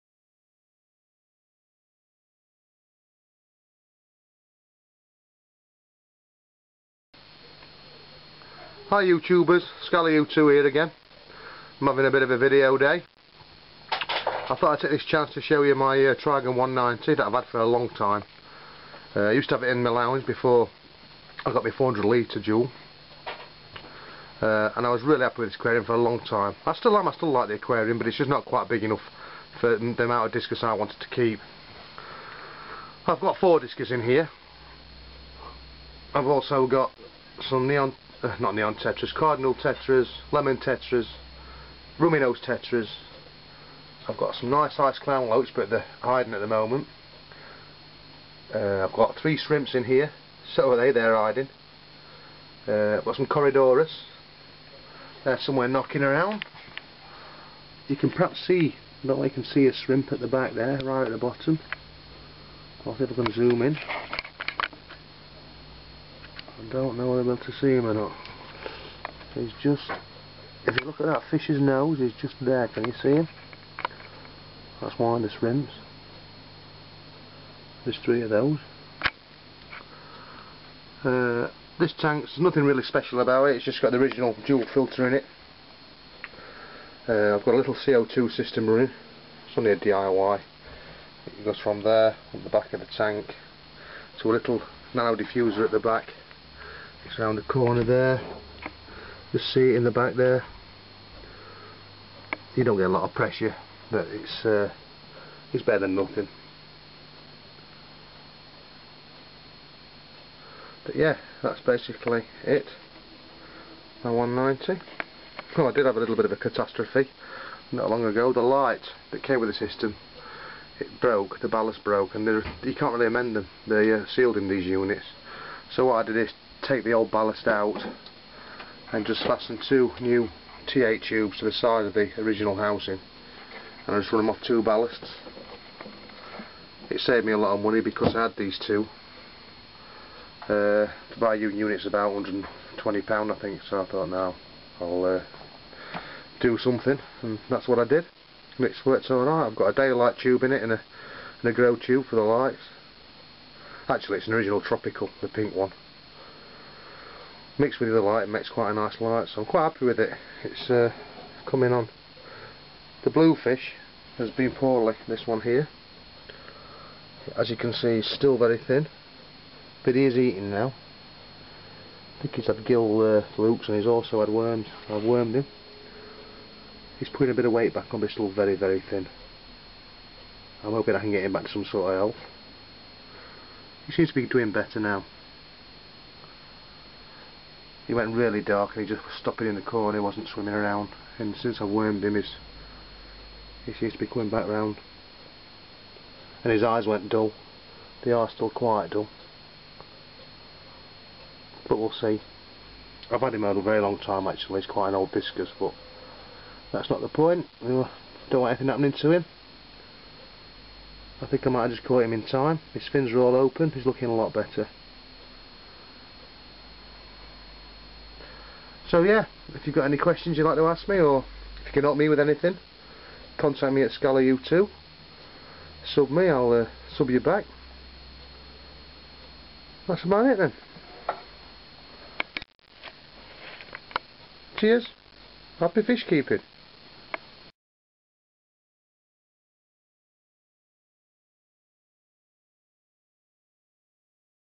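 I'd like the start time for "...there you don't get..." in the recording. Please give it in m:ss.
1:40.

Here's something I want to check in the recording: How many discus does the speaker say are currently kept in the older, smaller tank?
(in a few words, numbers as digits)
4.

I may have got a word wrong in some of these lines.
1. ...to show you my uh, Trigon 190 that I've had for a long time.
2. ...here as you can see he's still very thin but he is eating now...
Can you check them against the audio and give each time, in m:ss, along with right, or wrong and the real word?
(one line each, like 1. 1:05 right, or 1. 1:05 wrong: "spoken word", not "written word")
1. 0:15 right
2. 2:45 right.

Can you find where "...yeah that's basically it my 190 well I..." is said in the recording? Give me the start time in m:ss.
1:50.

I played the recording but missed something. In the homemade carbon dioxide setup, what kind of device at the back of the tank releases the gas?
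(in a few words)
nano diffuser.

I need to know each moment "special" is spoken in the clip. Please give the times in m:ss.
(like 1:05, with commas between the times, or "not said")
1:22.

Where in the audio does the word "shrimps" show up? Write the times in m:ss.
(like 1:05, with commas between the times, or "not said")
0:49, 0:59, 1:15.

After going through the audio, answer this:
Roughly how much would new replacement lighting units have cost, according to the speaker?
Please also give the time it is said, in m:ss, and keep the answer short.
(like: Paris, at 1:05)
£120, at 2:22.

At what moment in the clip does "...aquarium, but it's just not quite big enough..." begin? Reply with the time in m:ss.
0:27.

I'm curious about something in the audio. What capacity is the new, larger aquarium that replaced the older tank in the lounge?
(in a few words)
400 litres.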